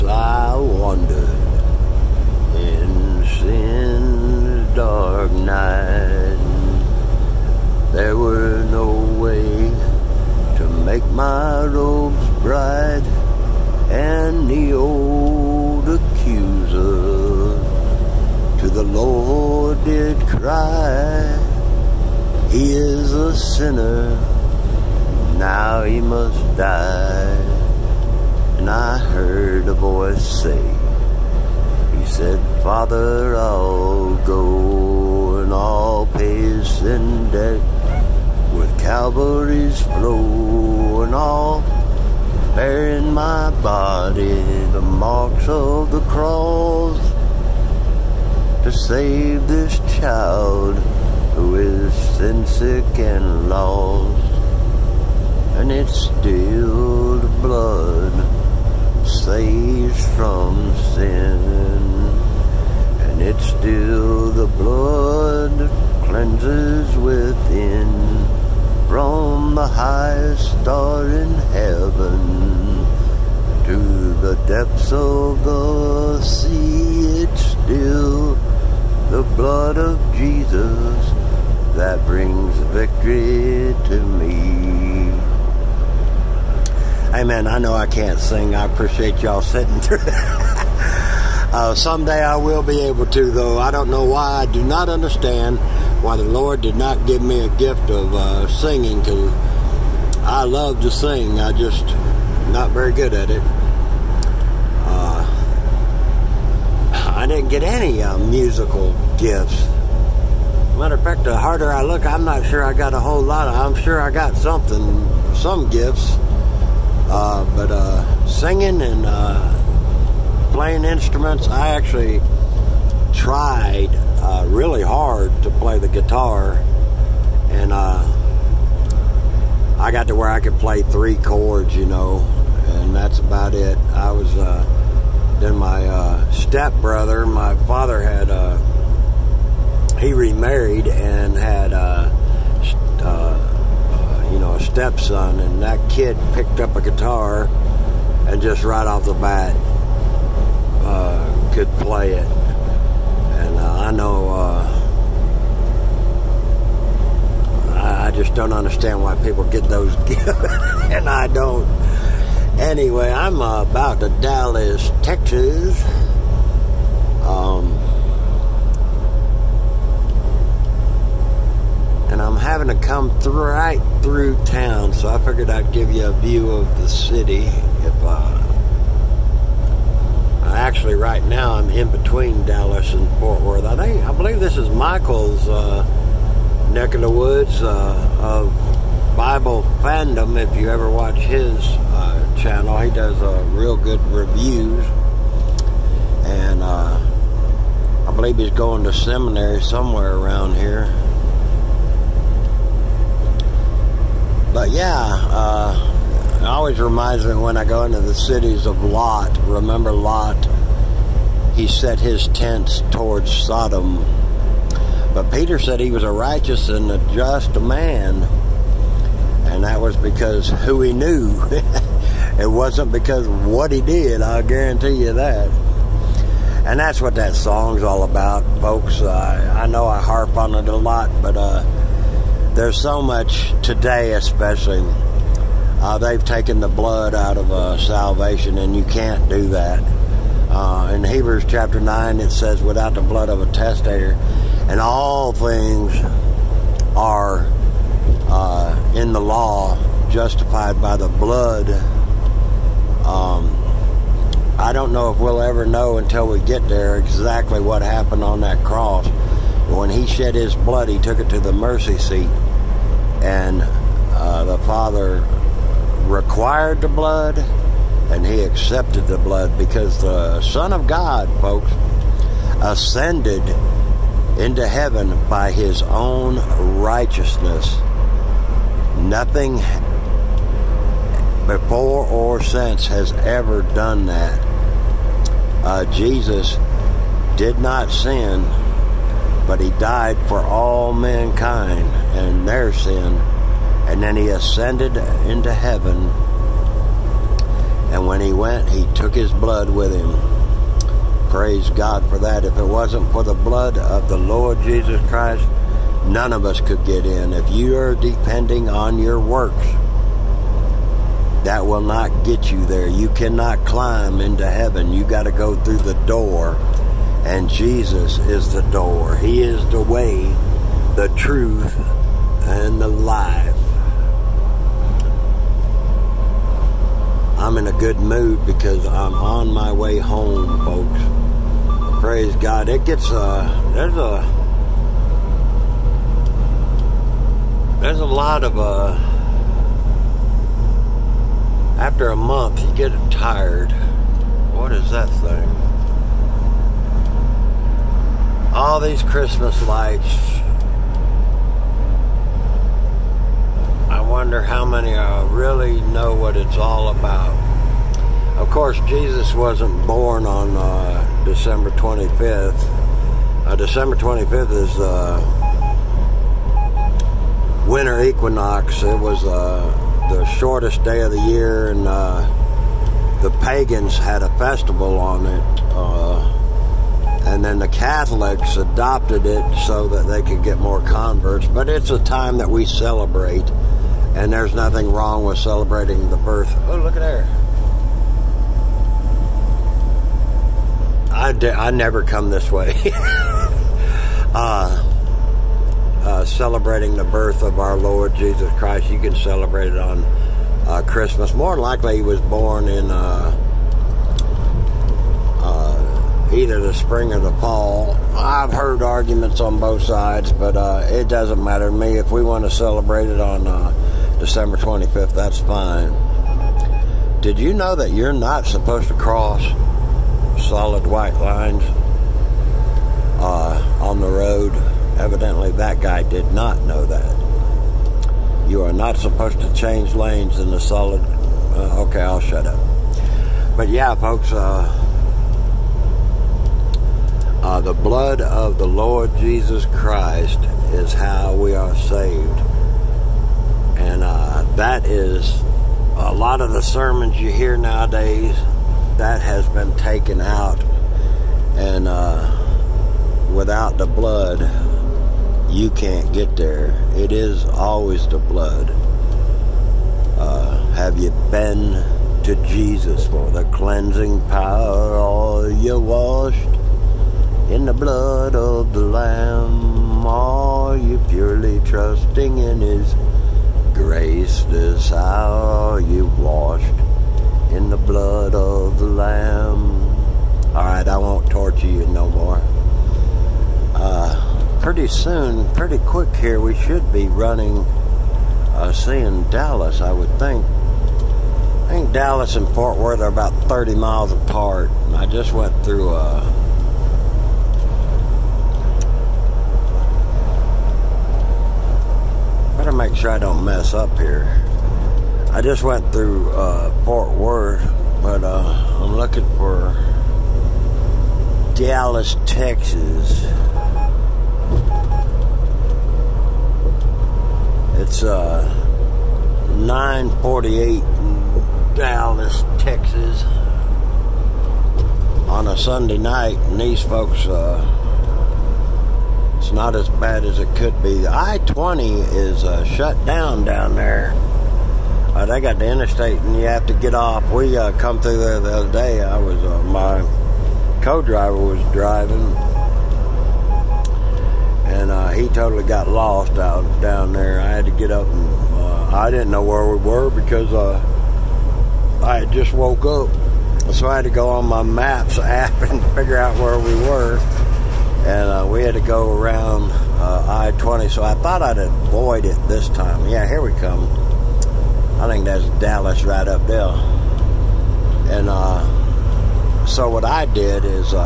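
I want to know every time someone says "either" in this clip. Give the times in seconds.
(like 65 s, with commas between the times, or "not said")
406 s.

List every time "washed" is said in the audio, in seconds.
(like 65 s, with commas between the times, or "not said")
465 s, 476 s.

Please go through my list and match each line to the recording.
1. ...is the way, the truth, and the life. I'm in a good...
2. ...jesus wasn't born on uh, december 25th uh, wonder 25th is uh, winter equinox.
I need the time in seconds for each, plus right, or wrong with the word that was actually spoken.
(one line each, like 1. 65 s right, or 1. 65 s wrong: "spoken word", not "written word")
1. 319 s right
2. 358 s wrong: "december", not "wonder".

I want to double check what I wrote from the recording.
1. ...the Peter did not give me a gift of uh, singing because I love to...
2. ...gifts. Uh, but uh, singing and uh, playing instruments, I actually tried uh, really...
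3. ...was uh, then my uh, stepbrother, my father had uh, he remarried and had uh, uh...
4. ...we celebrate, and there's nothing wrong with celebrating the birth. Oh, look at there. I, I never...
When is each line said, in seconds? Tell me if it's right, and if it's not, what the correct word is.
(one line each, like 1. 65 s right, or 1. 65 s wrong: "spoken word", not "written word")
1. 96 s wrong: "Lord", not "Peter"
2. 115 s right
3. 134 s right
4. 382 s right.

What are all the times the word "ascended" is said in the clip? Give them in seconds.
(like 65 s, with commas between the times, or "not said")
272 s, 294 s.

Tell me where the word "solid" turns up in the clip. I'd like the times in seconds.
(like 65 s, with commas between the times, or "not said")
420 s, 430 s.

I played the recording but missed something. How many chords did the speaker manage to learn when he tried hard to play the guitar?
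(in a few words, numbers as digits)
3.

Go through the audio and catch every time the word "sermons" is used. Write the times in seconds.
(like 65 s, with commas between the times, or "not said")
446 s.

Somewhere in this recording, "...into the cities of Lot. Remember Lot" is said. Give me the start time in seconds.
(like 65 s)
207 s.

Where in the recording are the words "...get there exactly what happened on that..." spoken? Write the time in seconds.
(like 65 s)
256 s.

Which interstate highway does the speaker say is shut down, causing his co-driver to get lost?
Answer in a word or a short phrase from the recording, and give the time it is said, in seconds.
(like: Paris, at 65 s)
I-20, at 530 s.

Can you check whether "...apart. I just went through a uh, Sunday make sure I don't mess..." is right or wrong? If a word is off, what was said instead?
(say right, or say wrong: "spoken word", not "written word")
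wrong: "Better", not "Sunday".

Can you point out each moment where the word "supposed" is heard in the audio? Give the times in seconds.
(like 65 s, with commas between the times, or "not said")
418 s, 428 s.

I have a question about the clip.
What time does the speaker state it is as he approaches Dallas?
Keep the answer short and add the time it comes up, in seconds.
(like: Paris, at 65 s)
9:48, at 519 s.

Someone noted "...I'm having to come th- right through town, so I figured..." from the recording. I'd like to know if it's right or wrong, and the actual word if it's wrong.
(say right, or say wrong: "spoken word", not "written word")
right.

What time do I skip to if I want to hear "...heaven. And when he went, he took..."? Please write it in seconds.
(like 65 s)
295 s.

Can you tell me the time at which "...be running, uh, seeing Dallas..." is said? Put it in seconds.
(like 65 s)
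486 s.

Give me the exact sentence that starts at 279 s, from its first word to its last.
Nothing before or since has ever done that.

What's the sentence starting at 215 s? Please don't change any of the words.
But Peter said he was a righteous and a just man and that was because who he knew.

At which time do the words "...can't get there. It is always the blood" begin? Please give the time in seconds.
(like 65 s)
455 s.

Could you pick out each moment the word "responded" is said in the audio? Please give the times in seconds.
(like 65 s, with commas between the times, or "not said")
not said.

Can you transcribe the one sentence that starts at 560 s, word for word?
So I thought I'd avoid it this time.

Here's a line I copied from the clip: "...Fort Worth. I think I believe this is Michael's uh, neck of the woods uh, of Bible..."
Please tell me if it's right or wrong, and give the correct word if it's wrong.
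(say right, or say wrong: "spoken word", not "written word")
right.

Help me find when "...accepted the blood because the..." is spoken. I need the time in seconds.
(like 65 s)
268 s.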